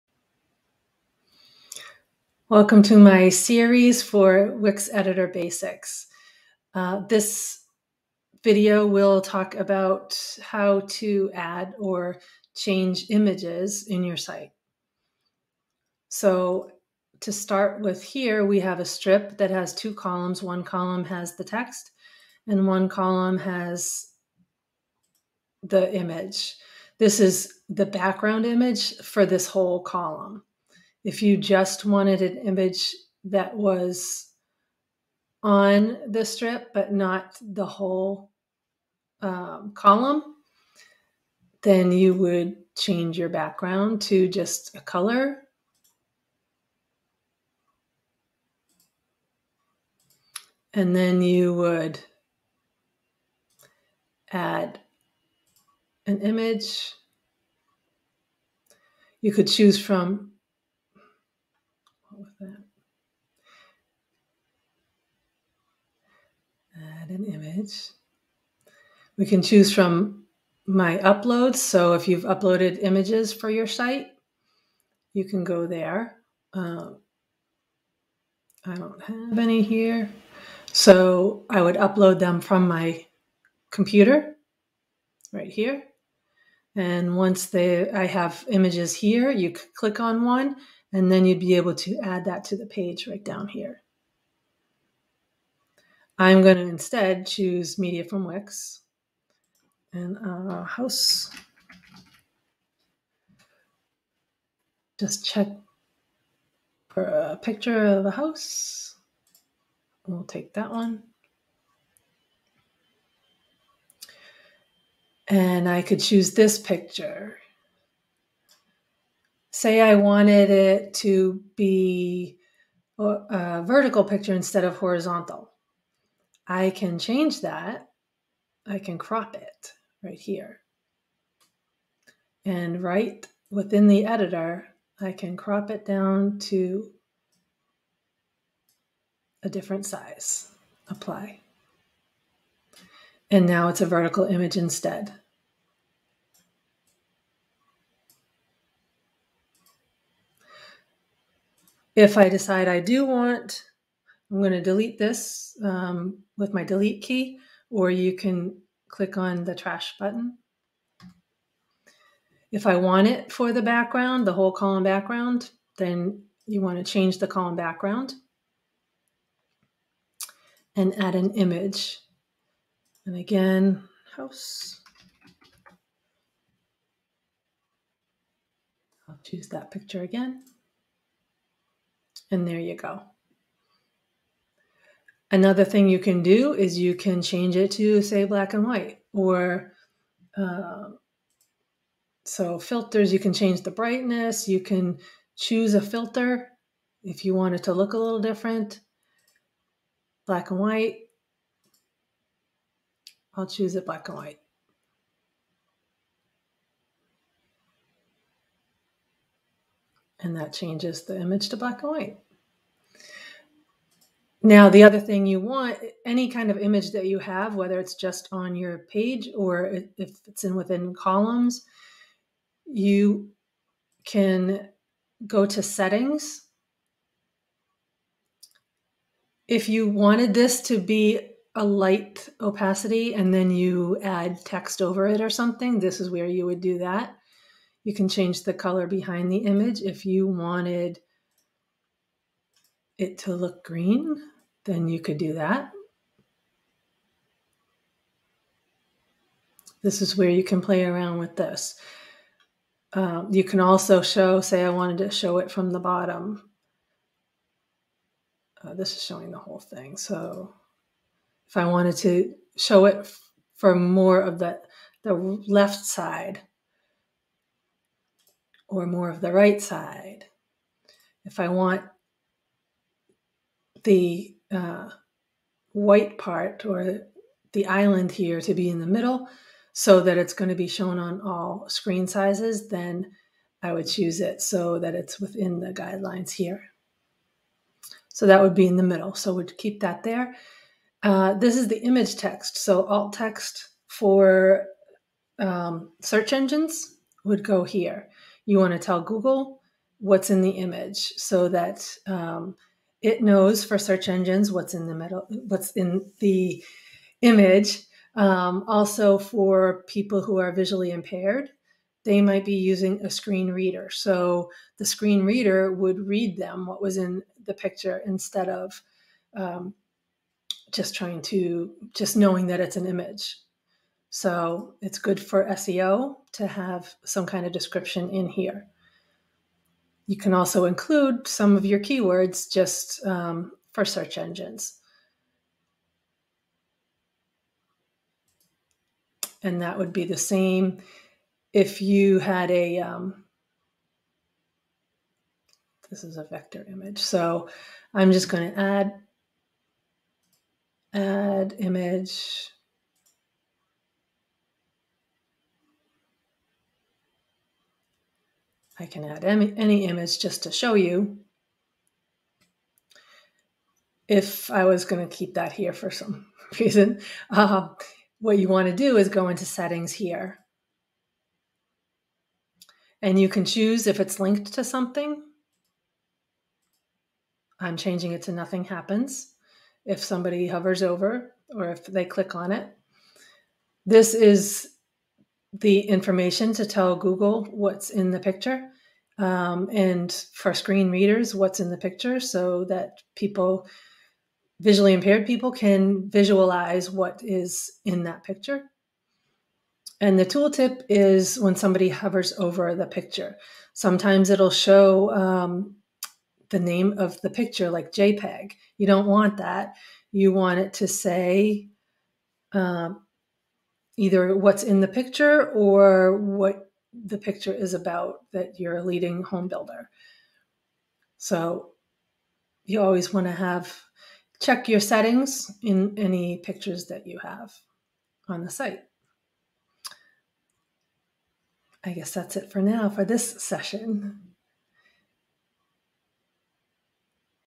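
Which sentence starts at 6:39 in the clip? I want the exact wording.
And the tooltip is when somebody hovers over the picture.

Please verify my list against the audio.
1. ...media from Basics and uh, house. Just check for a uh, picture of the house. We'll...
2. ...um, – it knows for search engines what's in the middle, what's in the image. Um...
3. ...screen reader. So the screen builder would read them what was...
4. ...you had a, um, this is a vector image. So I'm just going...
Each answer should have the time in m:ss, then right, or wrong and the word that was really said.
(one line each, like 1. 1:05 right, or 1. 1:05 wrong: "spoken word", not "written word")
1. 1:37 wrong: "Wix", not "Basics"
2. 5:02 right
3. 5:13 wrong: "reader", not "builder"
4. 5:41 right.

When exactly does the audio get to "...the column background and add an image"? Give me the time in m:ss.
2:47.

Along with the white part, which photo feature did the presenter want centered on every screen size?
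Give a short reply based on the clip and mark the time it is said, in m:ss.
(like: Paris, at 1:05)
the island, at 4:37.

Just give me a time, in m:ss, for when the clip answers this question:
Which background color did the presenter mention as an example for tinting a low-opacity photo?
4:03.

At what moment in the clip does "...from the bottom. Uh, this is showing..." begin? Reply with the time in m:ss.
4:15.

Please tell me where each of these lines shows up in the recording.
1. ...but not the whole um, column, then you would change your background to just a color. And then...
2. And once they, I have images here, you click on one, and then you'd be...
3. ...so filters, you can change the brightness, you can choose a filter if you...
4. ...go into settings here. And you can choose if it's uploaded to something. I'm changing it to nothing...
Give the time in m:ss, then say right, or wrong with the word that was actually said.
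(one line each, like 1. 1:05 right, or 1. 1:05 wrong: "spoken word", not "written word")
1. 0:36 right
2. 1:26 right
3. 3:12 right
4. 6:09 wrong: "linked", not "uploaded".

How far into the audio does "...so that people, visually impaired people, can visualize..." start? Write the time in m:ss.
6:32.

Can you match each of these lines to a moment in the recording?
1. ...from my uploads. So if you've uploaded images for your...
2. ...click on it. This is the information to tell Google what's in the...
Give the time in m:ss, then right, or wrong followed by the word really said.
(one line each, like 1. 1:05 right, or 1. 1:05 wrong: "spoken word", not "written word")
1. 1:09 right
2. 6:22 right.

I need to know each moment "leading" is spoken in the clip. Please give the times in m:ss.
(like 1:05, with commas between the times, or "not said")
6:58.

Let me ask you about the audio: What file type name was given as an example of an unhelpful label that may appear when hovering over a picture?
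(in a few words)
JPEG.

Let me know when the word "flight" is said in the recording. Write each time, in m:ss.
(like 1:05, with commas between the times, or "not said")
not said.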